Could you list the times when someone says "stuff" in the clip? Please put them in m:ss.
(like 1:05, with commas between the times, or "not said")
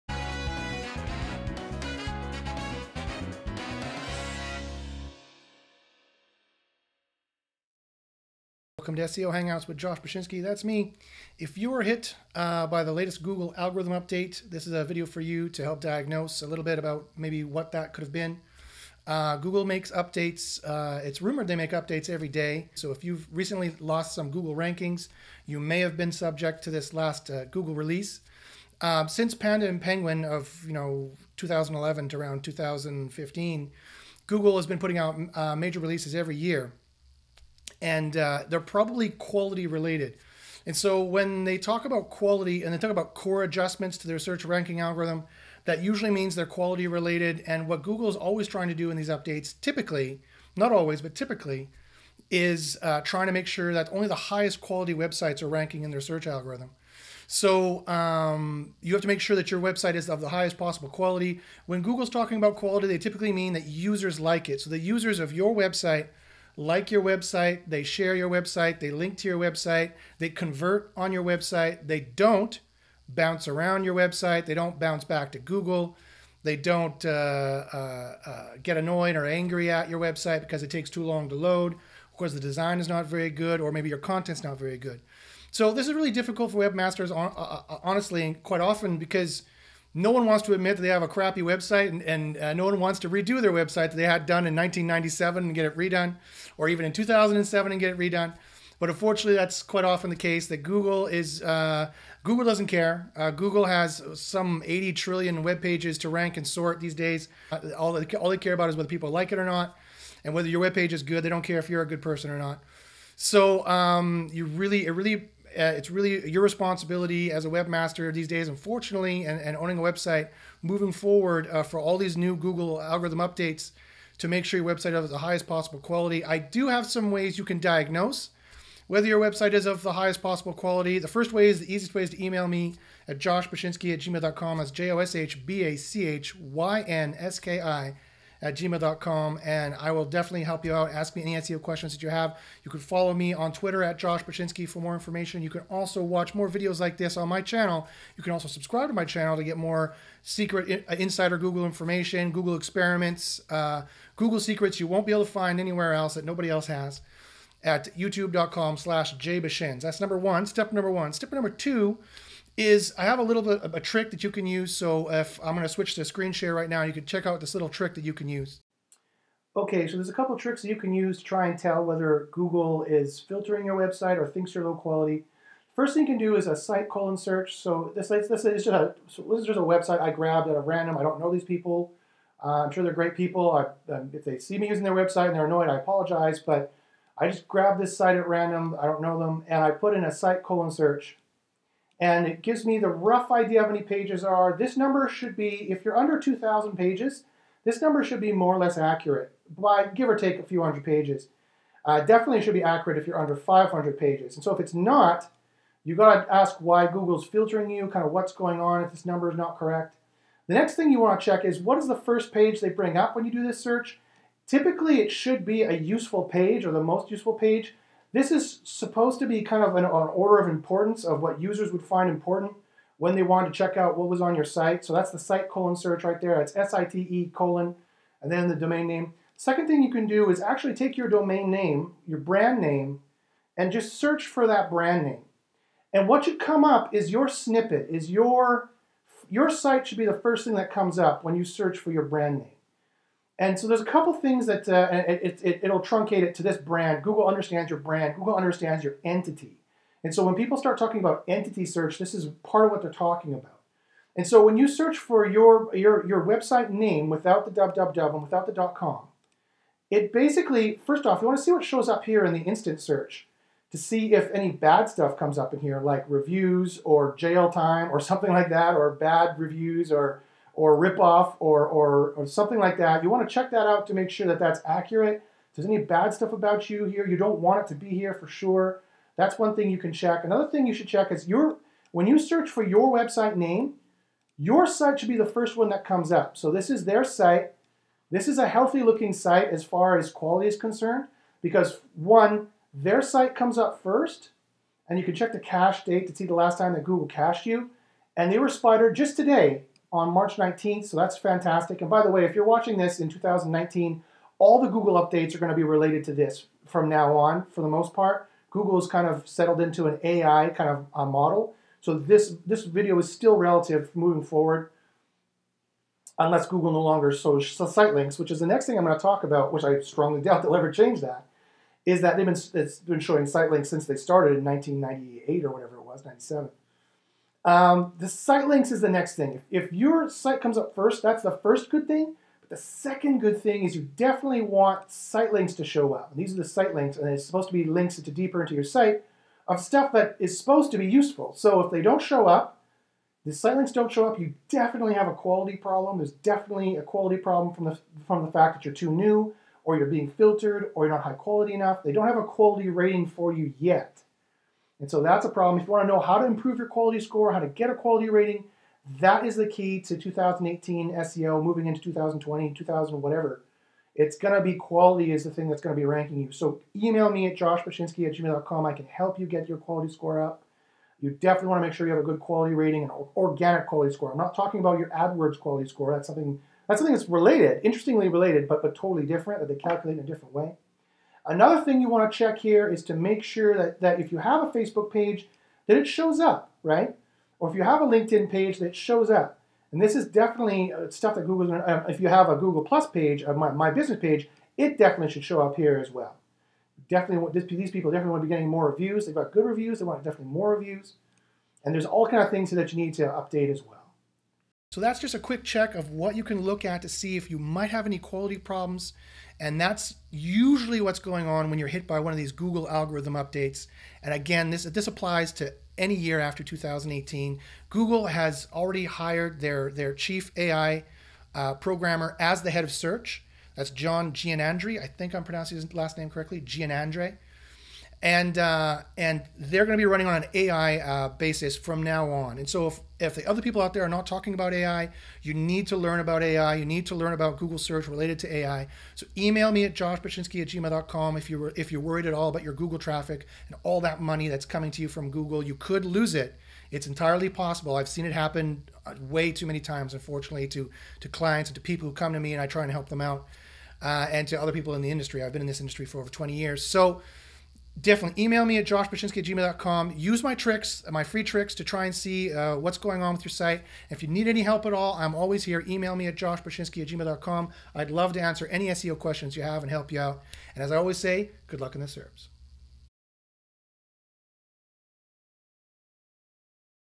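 4:24, 4:36, 5:39, 6:30.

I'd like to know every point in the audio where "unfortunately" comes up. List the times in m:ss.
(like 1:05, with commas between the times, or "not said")
1:38, 1:58, 7:29.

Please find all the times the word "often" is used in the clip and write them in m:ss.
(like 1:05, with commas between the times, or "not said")
1:28, 1:39.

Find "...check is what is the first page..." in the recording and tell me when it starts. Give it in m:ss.
3:31.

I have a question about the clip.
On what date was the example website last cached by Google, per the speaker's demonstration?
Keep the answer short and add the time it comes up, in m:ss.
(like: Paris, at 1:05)
March 19th, at 5:00.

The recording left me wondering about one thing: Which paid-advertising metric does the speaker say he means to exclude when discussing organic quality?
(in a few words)
AdWords quality score.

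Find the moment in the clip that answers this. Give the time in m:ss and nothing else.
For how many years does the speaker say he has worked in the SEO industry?
7:35.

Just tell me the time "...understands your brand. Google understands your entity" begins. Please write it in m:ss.
4:07.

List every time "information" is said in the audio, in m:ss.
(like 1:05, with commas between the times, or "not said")
2:24, 2:31.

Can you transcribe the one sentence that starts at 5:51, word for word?
They don't have a quality rating for you yet.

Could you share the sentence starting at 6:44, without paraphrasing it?
So that's just a quick check of what you can look at to see if you might have any quality problems.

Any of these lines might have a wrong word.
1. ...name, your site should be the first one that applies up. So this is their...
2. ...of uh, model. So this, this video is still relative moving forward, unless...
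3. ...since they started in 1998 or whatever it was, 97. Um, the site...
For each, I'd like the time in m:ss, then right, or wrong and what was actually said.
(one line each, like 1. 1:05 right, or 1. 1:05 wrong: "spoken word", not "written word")
1. 4:43 wrong: "comes", not "applies"
2. 5:10 right
3. 5:23 right.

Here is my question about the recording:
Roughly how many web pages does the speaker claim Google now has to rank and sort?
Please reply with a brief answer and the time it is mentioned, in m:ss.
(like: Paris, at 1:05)
80 trillion, at 1:44.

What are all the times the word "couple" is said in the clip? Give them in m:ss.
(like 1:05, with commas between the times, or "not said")
2:50, 4:03.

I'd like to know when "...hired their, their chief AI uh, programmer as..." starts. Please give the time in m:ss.
6:58.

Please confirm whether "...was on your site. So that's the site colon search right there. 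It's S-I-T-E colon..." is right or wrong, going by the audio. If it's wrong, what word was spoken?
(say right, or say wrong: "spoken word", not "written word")
right.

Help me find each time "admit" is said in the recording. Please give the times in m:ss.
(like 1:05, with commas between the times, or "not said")
1:30.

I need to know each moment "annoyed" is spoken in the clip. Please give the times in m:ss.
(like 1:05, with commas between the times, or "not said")
1:18, 3:05.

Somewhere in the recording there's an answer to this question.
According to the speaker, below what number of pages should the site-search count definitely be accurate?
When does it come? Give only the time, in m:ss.
3:23.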